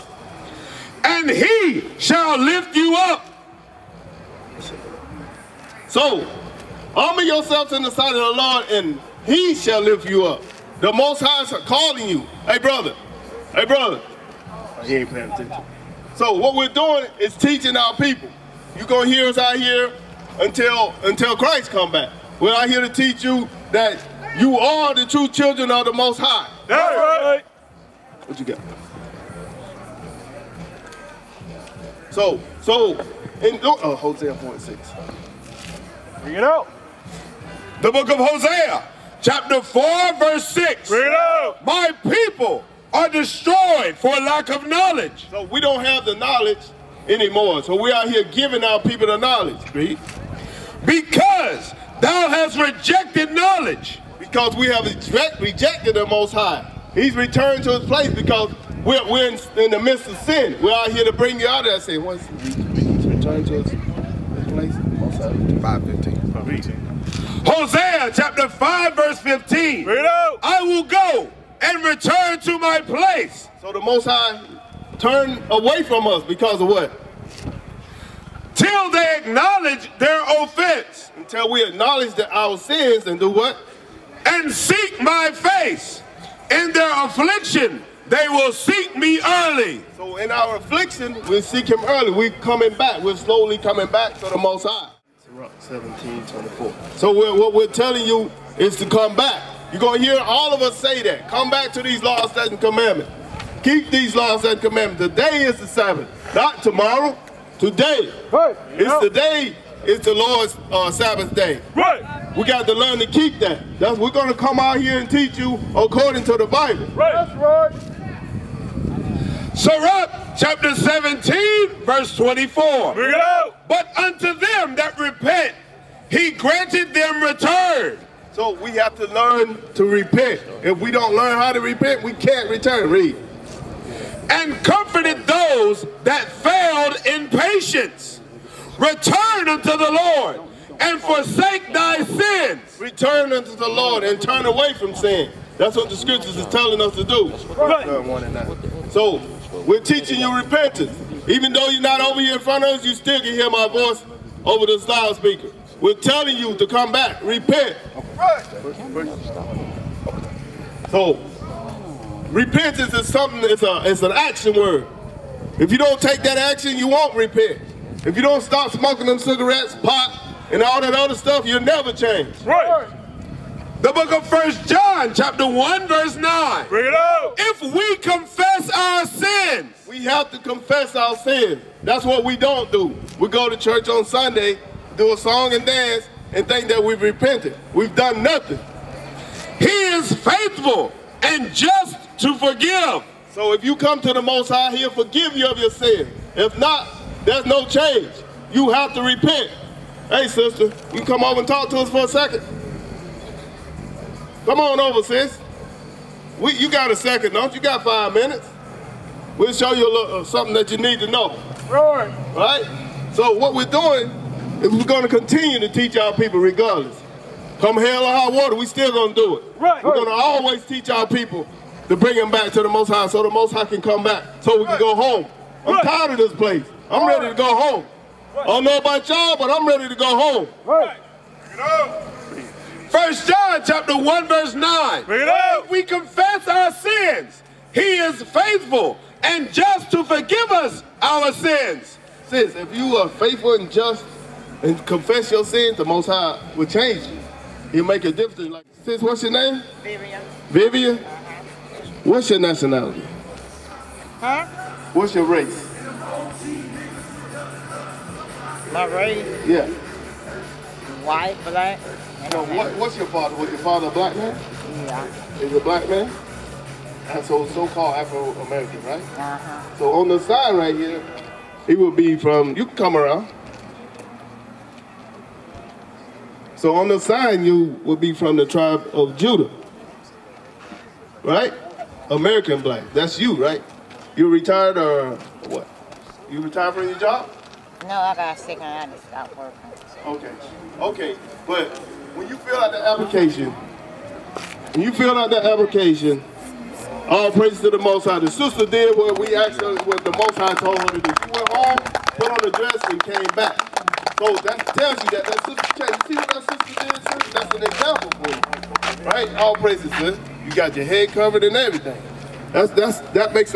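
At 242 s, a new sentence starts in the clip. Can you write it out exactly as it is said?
Sis, if you are faithful and just and confess your sins, the Most High will change you.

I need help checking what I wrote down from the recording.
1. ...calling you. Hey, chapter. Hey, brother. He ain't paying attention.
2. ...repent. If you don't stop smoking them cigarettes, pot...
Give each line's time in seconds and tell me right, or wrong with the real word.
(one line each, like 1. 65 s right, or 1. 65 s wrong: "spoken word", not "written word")
1. 11 s wrong: "brother", not "chapter"
2. 167 s right.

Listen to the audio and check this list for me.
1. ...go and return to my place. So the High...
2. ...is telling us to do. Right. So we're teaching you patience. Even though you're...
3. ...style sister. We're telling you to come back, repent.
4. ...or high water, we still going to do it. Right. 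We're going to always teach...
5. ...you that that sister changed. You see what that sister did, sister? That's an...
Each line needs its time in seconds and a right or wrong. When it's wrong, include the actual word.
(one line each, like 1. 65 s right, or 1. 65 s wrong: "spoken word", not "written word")
1. 70 s wrong: "Most", not "High"
2. 146 s wrong: "repentance", not "patience"
3. 154 s wrong: "speaker", not "sister"
4. 218 s right
5. 305 s right.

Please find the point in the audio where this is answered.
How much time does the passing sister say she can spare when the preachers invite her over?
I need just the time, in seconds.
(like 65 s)
207 s.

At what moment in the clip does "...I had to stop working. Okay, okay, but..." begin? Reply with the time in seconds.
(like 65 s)
288 s.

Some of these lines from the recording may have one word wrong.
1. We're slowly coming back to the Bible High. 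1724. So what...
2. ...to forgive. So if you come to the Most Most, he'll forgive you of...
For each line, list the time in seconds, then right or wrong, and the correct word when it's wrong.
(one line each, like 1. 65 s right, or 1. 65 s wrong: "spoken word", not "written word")
1. 93 s wrong: "Most", not "Bible"
2. 192 s wrong: "High", not "Most".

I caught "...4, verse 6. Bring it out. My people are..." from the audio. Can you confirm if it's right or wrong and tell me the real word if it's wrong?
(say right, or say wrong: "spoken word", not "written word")
right.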